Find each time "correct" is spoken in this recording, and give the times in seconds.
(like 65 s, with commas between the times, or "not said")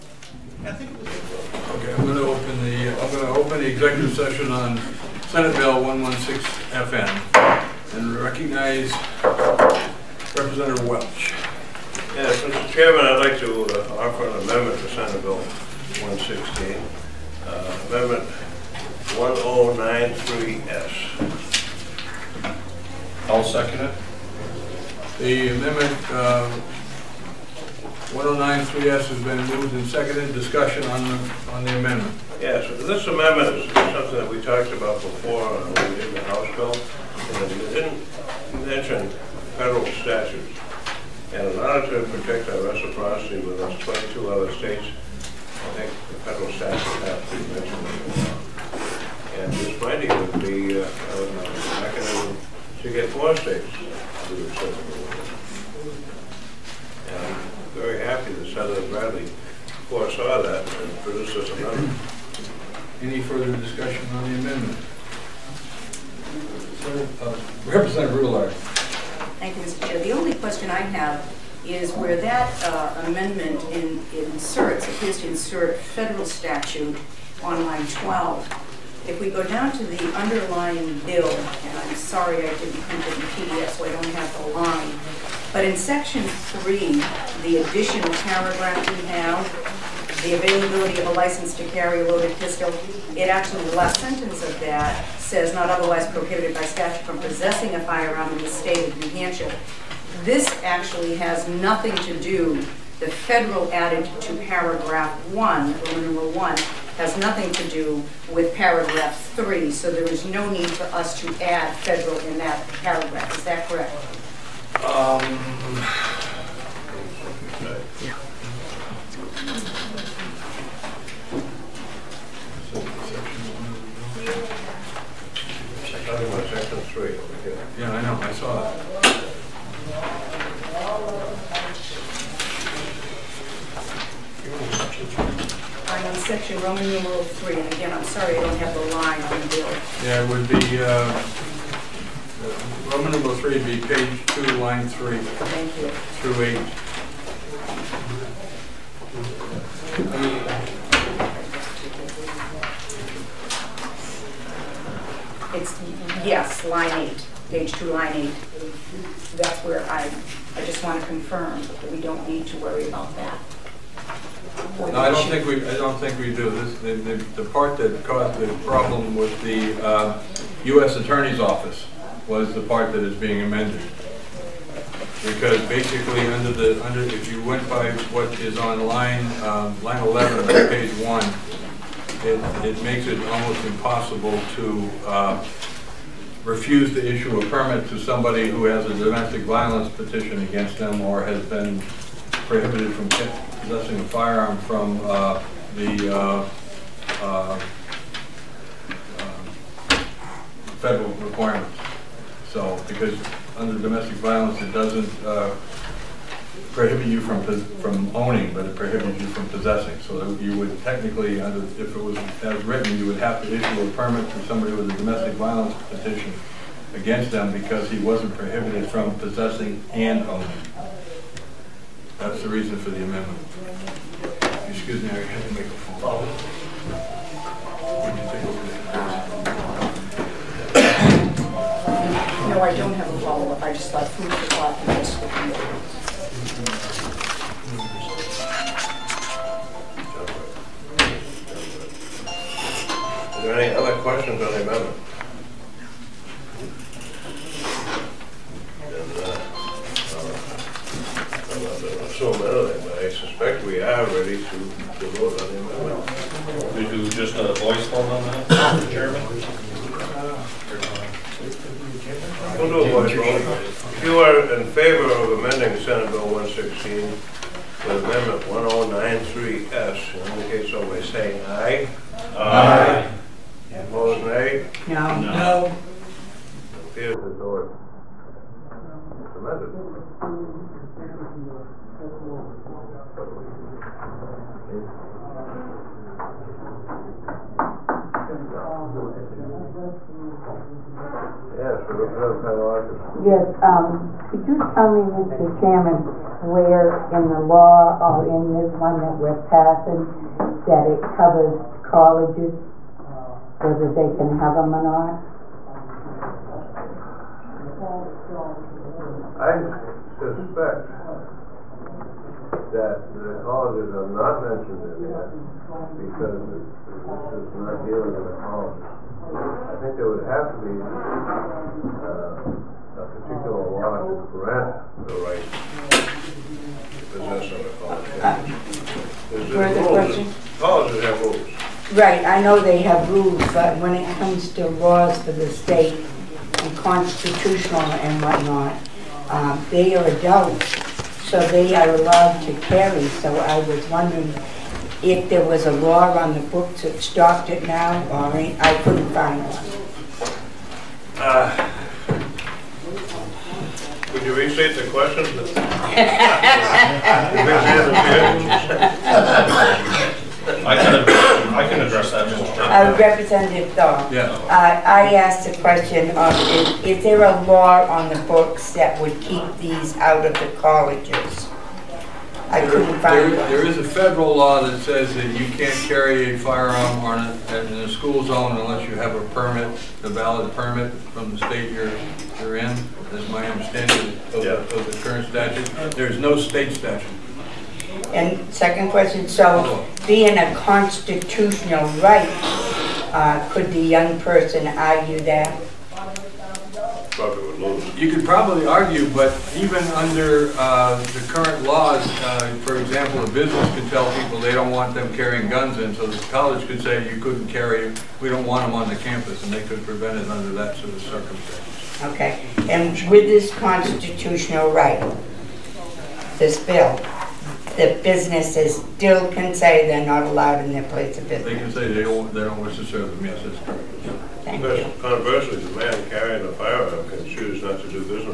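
113 s, 423 s.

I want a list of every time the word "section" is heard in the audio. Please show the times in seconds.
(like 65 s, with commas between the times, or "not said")
85 s, 136 s.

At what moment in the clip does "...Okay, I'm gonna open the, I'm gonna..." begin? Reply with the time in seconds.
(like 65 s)
1 s.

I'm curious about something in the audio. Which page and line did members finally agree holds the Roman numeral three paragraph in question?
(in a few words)
page 2, line 8.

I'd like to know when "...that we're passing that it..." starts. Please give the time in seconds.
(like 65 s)
298 s.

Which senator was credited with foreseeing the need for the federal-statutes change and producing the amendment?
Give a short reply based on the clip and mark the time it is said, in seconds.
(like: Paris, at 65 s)
Senator Bradley, at 58 s.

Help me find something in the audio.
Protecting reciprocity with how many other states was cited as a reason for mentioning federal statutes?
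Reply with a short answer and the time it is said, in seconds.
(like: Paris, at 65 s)
22, at 43 s.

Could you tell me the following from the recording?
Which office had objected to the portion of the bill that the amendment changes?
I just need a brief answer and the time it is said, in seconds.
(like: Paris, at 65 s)
U.S. Attorney's Office, at 170 s.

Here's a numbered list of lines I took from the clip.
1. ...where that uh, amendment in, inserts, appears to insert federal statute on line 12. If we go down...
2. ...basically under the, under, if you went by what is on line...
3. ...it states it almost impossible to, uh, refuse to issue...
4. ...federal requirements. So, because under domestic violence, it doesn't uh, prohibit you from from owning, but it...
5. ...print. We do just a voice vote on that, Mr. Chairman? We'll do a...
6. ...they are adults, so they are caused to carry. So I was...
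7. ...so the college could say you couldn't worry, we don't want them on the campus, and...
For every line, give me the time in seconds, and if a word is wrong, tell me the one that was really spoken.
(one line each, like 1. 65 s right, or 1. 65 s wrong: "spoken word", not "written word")
1. 71 s right
2. 175 s right
3. 182 s wrong: "makes", not "states"
4. 200 s right
5. 255 s wrong: "amendment", not "print"
6. 339 s wrong: "allowed", not "caused"
7. 405 s wrong: "carry", not "worry".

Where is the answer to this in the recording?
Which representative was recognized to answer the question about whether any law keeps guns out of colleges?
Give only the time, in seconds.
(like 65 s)
363 s.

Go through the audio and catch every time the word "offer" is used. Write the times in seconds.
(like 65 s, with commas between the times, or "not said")
14 s.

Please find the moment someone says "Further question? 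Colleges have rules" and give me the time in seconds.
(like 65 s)
329 s.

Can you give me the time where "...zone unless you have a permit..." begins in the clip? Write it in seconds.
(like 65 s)
378 s.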